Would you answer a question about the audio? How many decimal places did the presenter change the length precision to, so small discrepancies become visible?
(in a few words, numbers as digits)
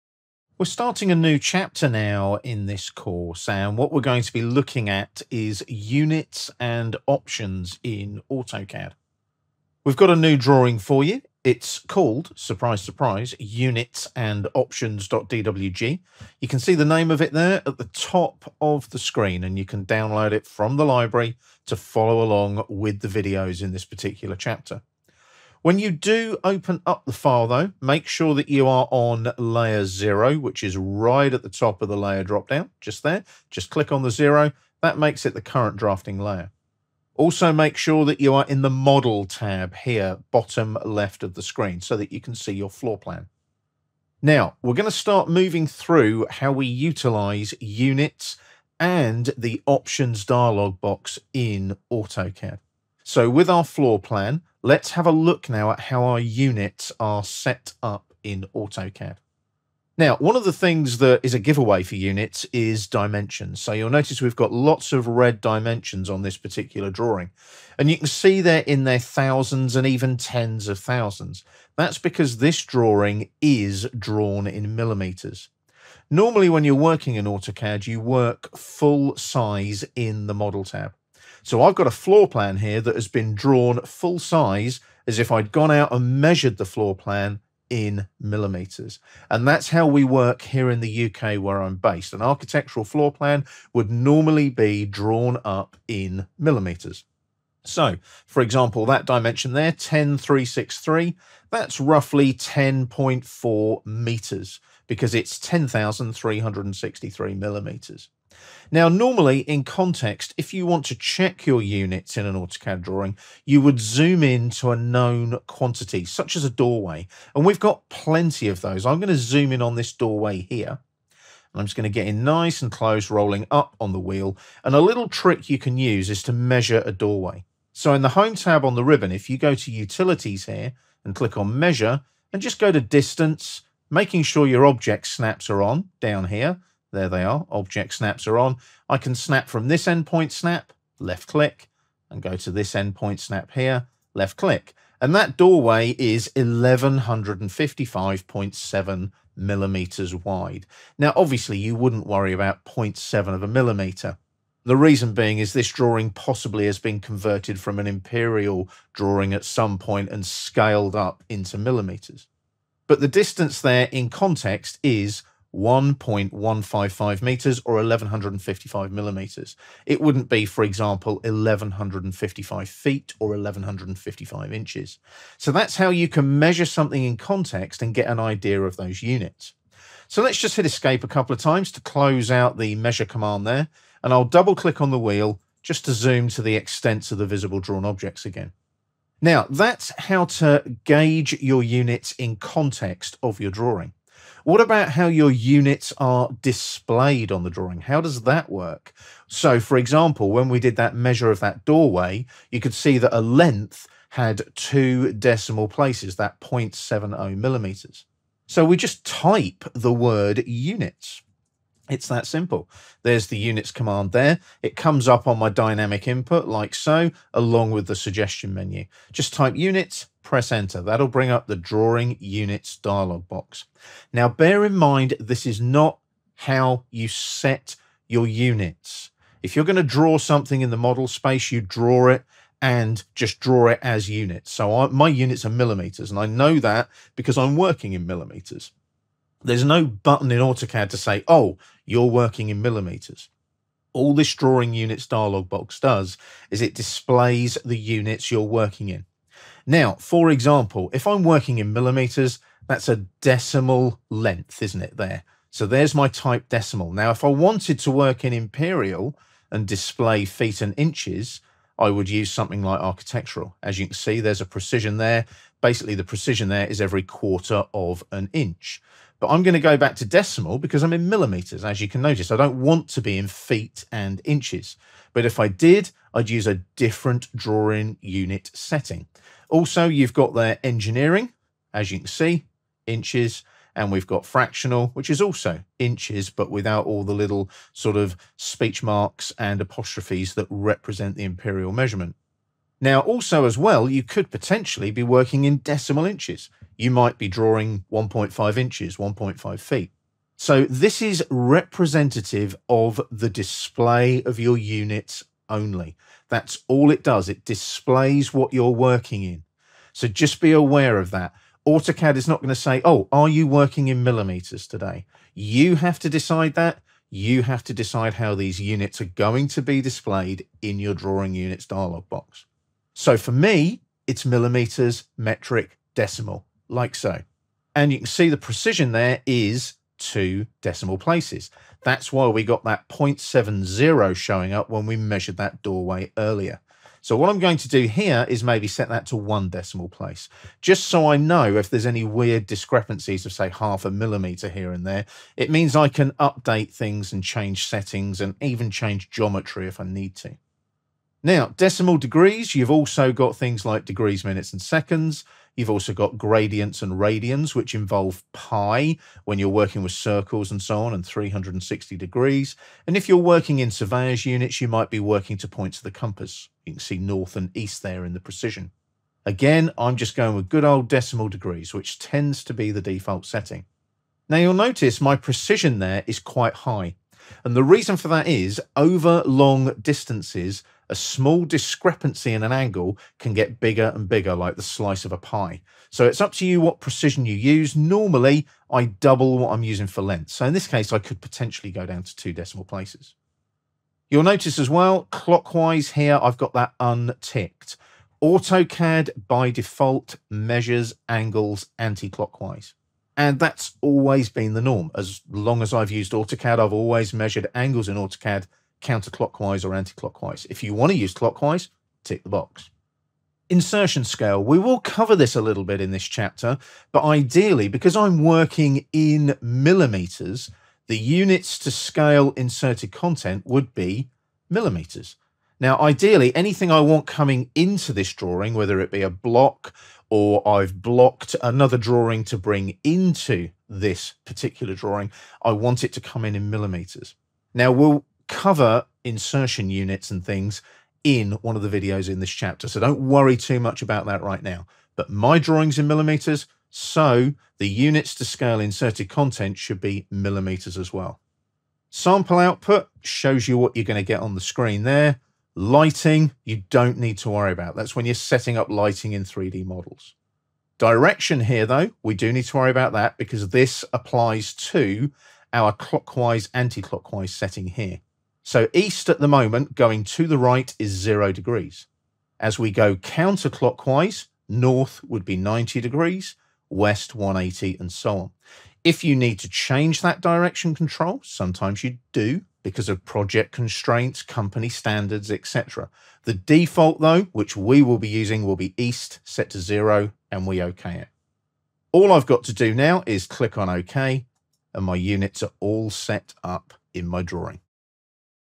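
1.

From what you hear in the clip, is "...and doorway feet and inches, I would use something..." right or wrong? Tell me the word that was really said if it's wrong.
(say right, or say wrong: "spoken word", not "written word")
wrong: "display", not "doorway".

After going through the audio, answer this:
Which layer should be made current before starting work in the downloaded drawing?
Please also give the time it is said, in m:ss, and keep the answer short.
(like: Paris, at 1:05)
layer zero, at 0:29.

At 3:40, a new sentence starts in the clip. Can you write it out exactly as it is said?
That'll bring up the drawing units dialog box.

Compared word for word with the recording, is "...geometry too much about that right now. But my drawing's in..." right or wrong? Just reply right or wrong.
wrong.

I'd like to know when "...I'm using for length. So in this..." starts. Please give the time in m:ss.
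6:29.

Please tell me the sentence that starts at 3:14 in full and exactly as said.
What about how your units are displayed on the drawing?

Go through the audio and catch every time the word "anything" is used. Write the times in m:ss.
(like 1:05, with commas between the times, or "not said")
7:06.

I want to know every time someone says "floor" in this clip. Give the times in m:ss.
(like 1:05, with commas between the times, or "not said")
0:42, 0:53, 1:21, 1:26, 1:32.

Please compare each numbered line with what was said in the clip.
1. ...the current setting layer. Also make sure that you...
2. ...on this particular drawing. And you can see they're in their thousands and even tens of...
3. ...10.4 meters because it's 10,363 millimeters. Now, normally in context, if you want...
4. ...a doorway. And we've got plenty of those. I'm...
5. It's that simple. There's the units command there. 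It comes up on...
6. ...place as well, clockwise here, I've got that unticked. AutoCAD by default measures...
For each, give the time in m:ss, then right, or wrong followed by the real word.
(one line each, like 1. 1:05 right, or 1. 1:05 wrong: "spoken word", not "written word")
1. 0:35 wrong: "drafting", not "setting"
2. 1:06 right
3. 1:42 right
4. 1:56 right
5. 3:31 right
6. 6:34 wrong: "notice", not "place".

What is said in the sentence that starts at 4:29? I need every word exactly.
But I'm going to go back to decimal because I'm in millimeters, as you can notice.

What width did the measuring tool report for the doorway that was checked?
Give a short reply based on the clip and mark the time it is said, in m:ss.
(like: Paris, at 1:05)
1155.7 millimeters, at 2:26.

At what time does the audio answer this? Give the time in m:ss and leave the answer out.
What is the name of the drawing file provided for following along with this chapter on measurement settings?
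0:13.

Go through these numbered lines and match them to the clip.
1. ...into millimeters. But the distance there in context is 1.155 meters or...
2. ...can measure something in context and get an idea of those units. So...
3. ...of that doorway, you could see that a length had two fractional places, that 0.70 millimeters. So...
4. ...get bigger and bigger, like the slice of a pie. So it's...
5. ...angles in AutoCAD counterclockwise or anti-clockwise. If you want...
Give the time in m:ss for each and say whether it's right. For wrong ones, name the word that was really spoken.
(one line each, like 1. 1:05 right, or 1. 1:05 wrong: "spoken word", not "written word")
1. 2:41 right
2. 2:56 right
3. 3:21 wrong: "decimal", not "fractional"
4. 6:23 right
5. 6:47 right.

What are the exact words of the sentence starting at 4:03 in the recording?
All this drawing units dialog box does is it displays the units you're working in.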